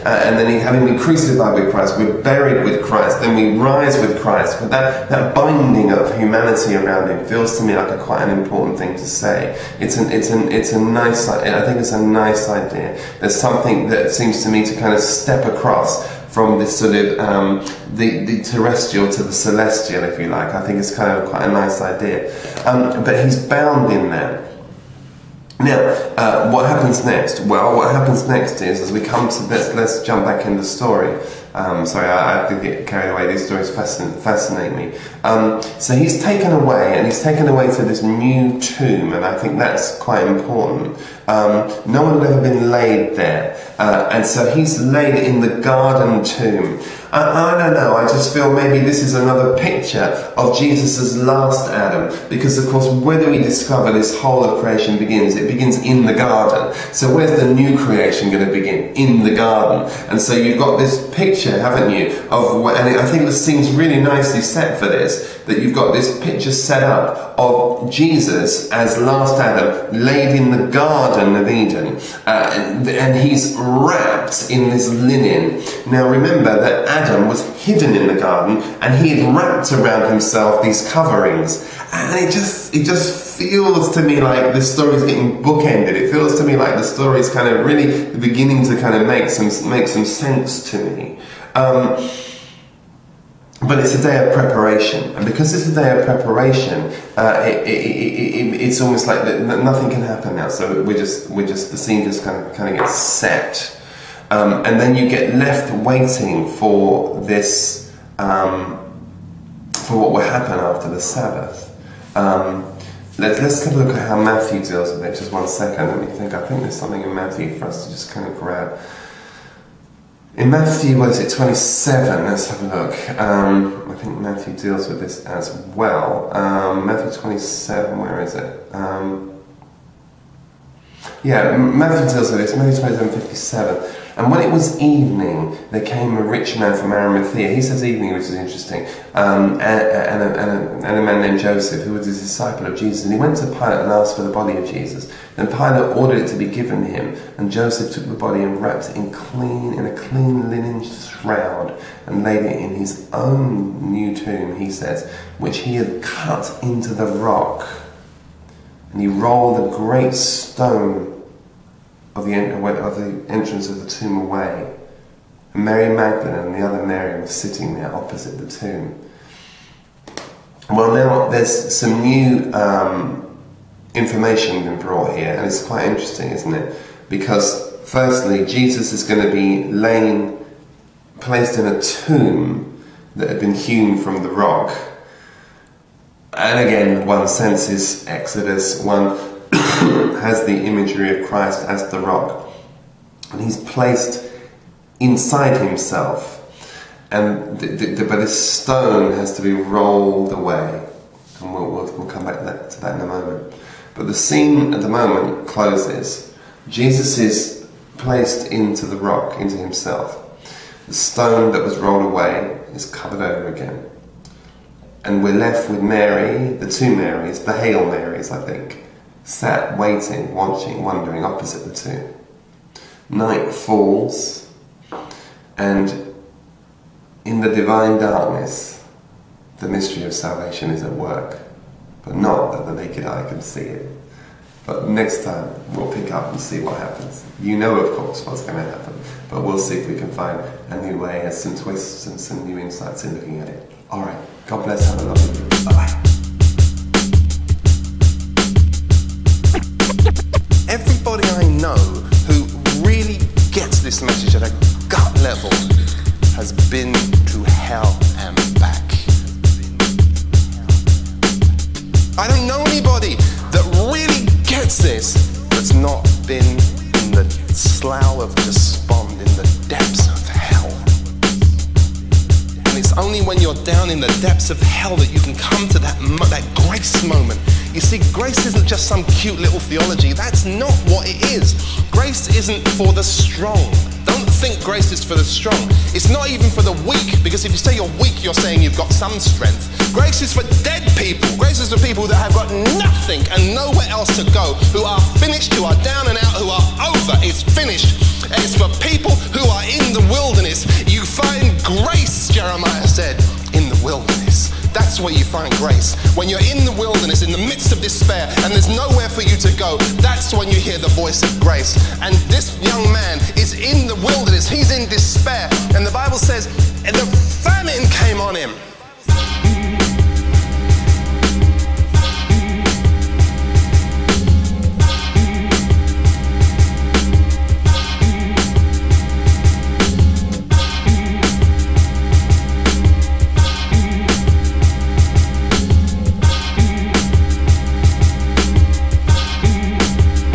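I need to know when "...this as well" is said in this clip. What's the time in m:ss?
2:04.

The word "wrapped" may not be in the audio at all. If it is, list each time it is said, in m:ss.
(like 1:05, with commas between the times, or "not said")
1:13, 1:19, 2:28.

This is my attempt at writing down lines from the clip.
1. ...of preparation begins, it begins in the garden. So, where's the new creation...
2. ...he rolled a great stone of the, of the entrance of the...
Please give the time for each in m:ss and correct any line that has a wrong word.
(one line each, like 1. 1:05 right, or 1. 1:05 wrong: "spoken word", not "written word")
1. 0:54 wrong: "creation", not "preparation"
2. 2:39 right.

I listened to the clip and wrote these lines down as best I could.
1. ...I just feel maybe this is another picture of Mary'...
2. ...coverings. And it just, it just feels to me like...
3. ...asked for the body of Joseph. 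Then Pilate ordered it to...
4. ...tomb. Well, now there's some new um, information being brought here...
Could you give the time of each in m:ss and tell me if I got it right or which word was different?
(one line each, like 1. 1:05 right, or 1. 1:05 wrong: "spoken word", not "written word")
1. 0:47 wrong: "Jesus", not "Mary"
2. 1:20 right
3. 2:23 wrong: "Jesus", not "Joseph"
4. 2:48 right.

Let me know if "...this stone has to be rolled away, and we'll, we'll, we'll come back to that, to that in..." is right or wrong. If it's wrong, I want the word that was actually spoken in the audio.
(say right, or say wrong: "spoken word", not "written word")
right.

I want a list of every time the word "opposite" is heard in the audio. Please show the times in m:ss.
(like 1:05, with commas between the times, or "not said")
2:47, 3:41.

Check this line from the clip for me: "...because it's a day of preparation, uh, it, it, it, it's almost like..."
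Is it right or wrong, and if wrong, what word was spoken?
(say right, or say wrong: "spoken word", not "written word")
right.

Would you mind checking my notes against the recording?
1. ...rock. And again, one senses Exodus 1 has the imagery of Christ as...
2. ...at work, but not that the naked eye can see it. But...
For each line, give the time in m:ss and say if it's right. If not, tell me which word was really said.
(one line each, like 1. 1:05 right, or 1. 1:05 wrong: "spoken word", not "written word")
1. 3:04 right
2. 3:50 right.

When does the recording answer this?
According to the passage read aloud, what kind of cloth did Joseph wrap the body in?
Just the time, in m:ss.
2:29.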